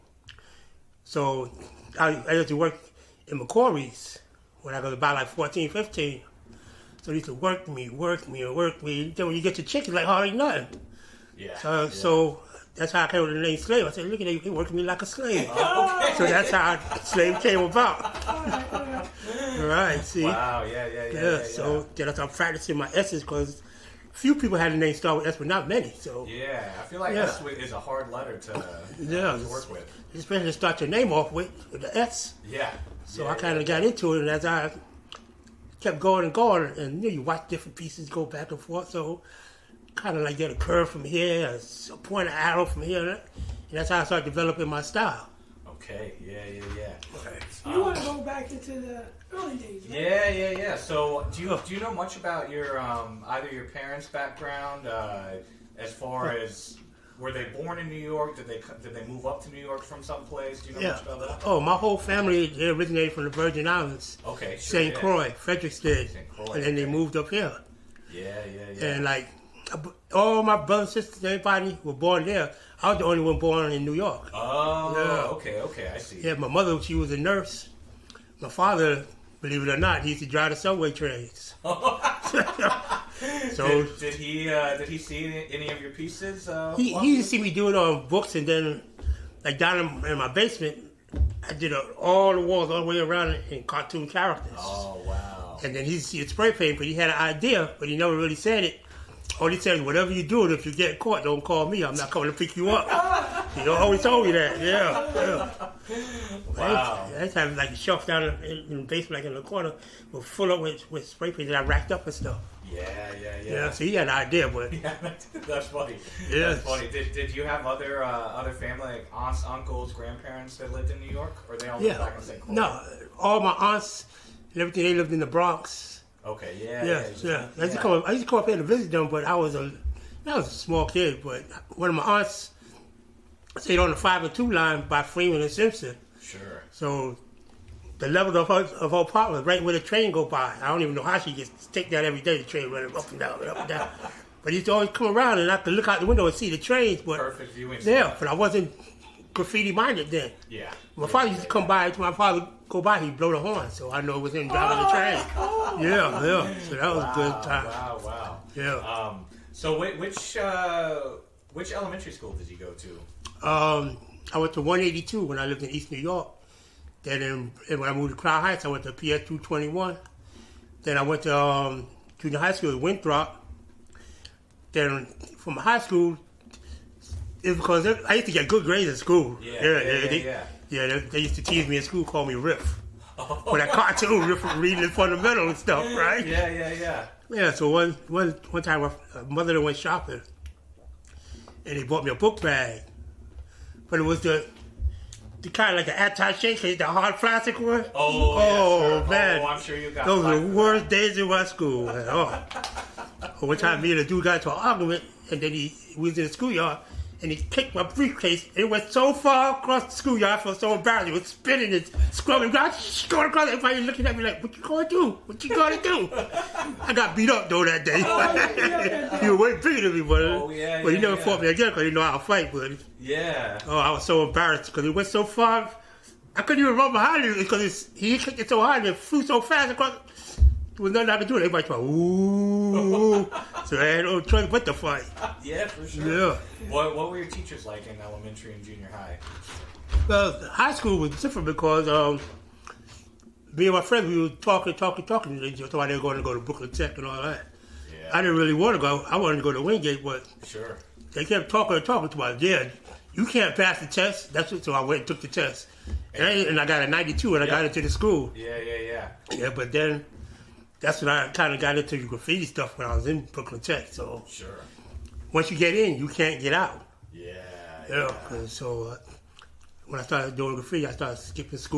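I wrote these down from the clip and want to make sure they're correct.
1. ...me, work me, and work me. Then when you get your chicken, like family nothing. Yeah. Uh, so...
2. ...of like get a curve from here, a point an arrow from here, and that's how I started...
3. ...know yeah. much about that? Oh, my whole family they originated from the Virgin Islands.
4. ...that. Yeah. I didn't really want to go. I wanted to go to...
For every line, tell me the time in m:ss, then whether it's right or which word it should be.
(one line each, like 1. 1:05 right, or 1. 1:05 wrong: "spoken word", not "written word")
1. 0:07 wrong: "hardly", not "family"
2. 0:40 right
3. 1:00 right
4. 4:07 right.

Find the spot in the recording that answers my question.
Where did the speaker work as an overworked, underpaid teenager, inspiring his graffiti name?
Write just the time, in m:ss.
0:03.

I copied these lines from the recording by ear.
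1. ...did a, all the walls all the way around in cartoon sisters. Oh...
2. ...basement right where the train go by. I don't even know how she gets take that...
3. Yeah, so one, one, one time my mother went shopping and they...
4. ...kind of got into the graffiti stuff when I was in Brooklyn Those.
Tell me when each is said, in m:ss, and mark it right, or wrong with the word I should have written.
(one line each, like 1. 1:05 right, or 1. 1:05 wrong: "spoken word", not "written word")
1. 1:31 wrong: "characters", not "sisters"
2. 2:18 wrong: "apartment", not "basement"
3. 3:07 right
4. 4:21 wrong: "Tech", not "Those".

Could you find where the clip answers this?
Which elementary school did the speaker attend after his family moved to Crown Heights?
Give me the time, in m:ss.
2:48.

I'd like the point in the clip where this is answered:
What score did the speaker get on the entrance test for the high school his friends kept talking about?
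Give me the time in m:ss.
4:16.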